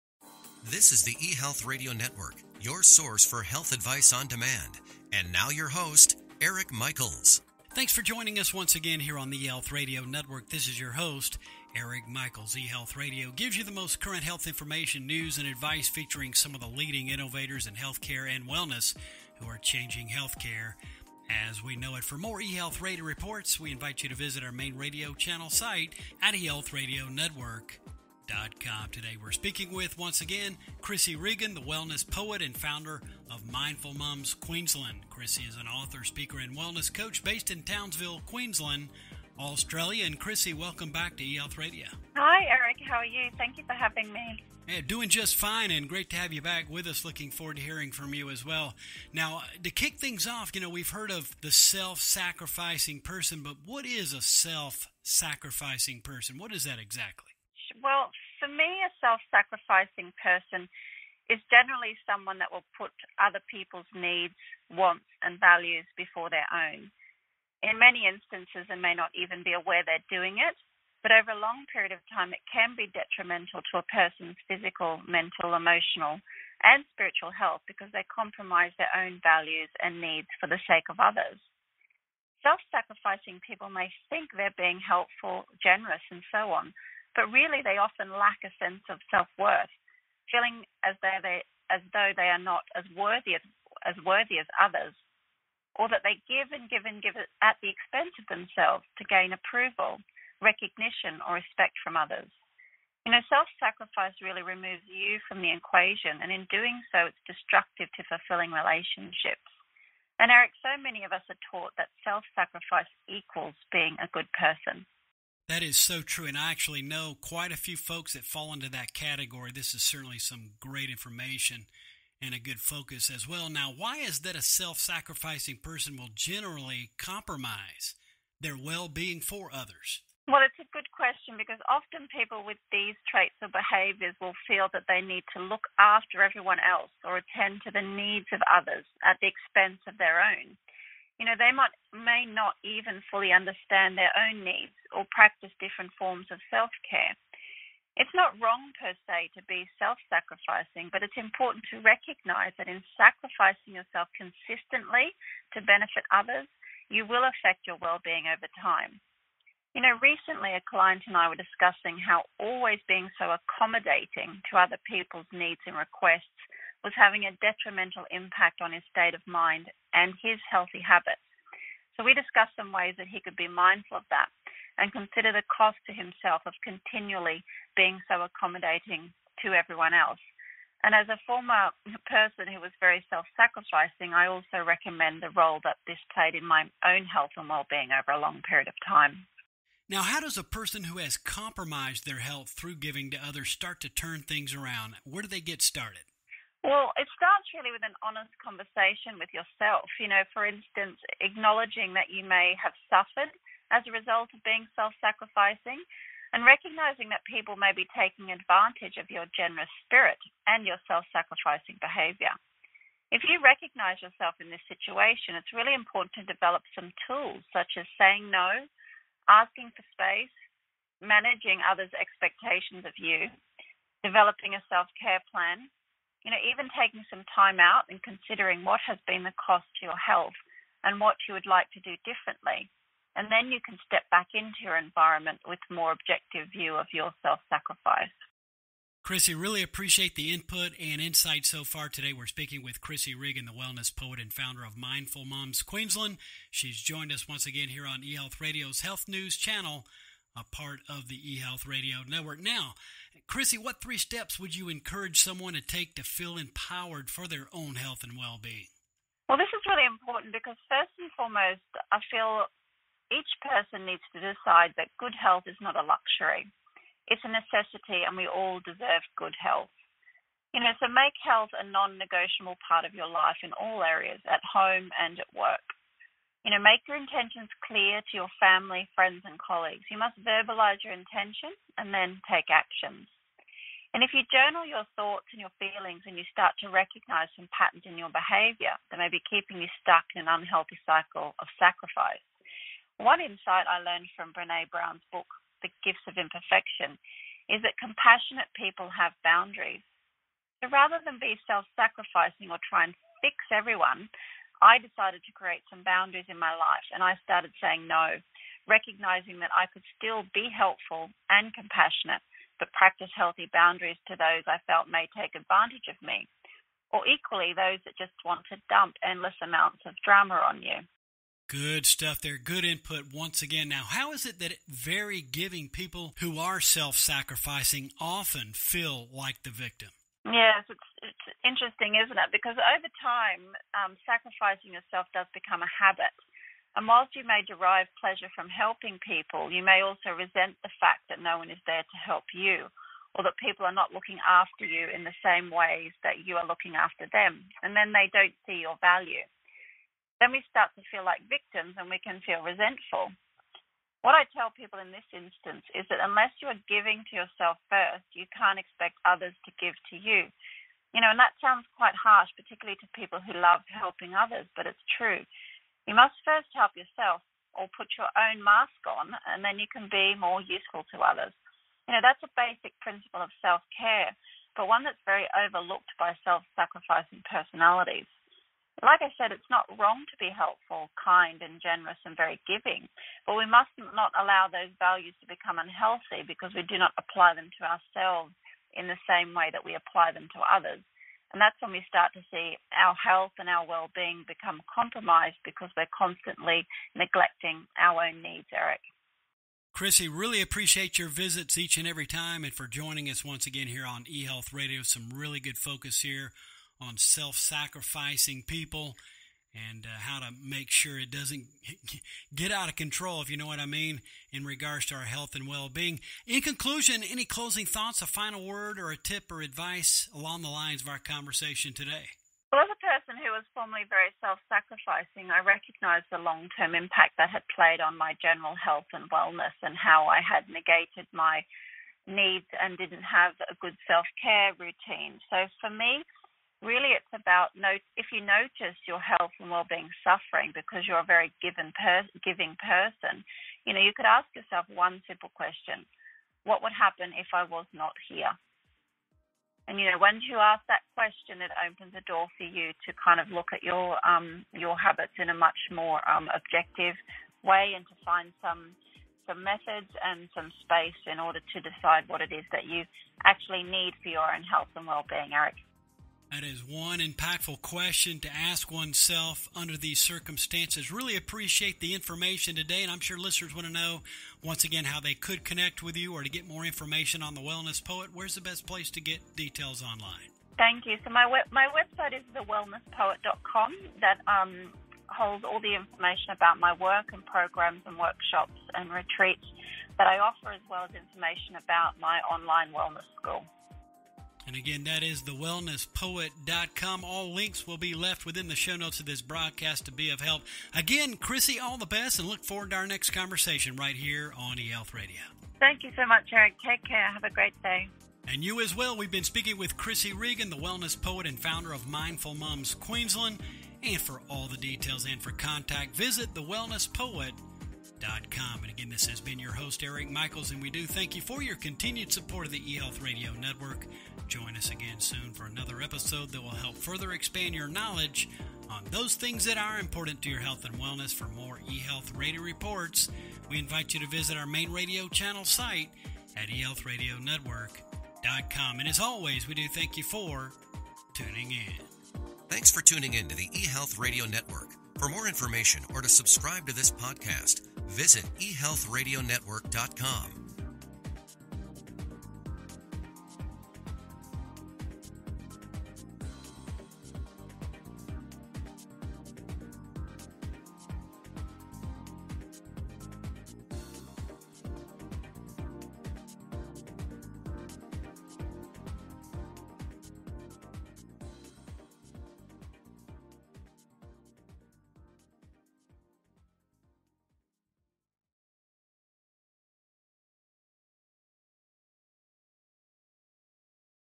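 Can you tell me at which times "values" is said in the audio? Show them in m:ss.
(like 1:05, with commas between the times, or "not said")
1:05, 1:19, 5:48, 6:24.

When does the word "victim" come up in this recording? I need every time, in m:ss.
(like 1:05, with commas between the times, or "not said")
5:29, 5:51.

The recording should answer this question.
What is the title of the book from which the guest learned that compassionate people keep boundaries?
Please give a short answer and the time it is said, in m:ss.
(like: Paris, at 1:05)
The Gifts of Imperfection, at 4:55.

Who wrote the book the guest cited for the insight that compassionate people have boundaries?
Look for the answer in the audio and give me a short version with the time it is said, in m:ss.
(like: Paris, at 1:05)
Brene Brown, at 4:54.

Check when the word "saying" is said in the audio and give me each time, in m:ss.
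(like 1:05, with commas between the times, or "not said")
3:37, 5:07.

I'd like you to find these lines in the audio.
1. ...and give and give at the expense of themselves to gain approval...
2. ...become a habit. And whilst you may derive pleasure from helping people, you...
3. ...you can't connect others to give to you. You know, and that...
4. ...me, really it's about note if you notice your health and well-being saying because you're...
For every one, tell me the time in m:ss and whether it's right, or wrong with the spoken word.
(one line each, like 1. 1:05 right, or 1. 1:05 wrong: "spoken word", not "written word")
1. 1:36 right
2. 5:35 right
3. 5:58 wrong: "expect", not "connect"
4. 7:15 wrong: "suffering", not "saying".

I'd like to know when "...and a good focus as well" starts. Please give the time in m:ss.
2:02.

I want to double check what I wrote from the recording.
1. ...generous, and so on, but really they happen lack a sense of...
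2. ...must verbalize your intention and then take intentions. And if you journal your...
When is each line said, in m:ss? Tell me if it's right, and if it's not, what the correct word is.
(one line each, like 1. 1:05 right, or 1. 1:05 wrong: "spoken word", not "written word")
1. 1:25 wrong: "often", not "happen"
2. 4:40 wrong: "actions", not "intentions".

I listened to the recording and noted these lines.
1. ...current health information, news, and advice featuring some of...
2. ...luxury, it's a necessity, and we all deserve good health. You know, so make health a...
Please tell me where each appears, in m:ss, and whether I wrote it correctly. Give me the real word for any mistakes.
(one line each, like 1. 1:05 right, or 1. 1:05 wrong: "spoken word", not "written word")
1. 0:13 right
2. 4:25 right.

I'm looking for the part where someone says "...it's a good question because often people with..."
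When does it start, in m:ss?
2:10.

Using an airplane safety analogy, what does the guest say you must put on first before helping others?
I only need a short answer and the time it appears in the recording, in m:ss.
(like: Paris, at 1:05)
your own mask, at 6:07.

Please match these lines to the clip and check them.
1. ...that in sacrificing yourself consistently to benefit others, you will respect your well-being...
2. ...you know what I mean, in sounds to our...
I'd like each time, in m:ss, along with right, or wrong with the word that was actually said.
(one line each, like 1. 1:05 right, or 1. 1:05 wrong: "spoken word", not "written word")
1. 2:32 wrong: "affect", not "respect"
2. 6:53 wrong: "regards", not "sounds".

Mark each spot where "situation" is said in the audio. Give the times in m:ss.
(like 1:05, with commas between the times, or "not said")
3:34.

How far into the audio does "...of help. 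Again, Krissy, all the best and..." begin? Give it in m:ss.
8:20.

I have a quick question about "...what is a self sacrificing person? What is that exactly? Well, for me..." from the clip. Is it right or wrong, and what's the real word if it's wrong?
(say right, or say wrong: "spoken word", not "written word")
right.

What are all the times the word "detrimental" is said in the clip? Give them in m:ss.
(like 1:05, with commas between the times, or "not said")
1:12, 2:47.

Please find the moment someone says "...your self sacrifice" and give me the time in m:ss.
3:56.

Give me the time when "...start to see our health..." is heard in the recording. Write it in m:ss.
6:31.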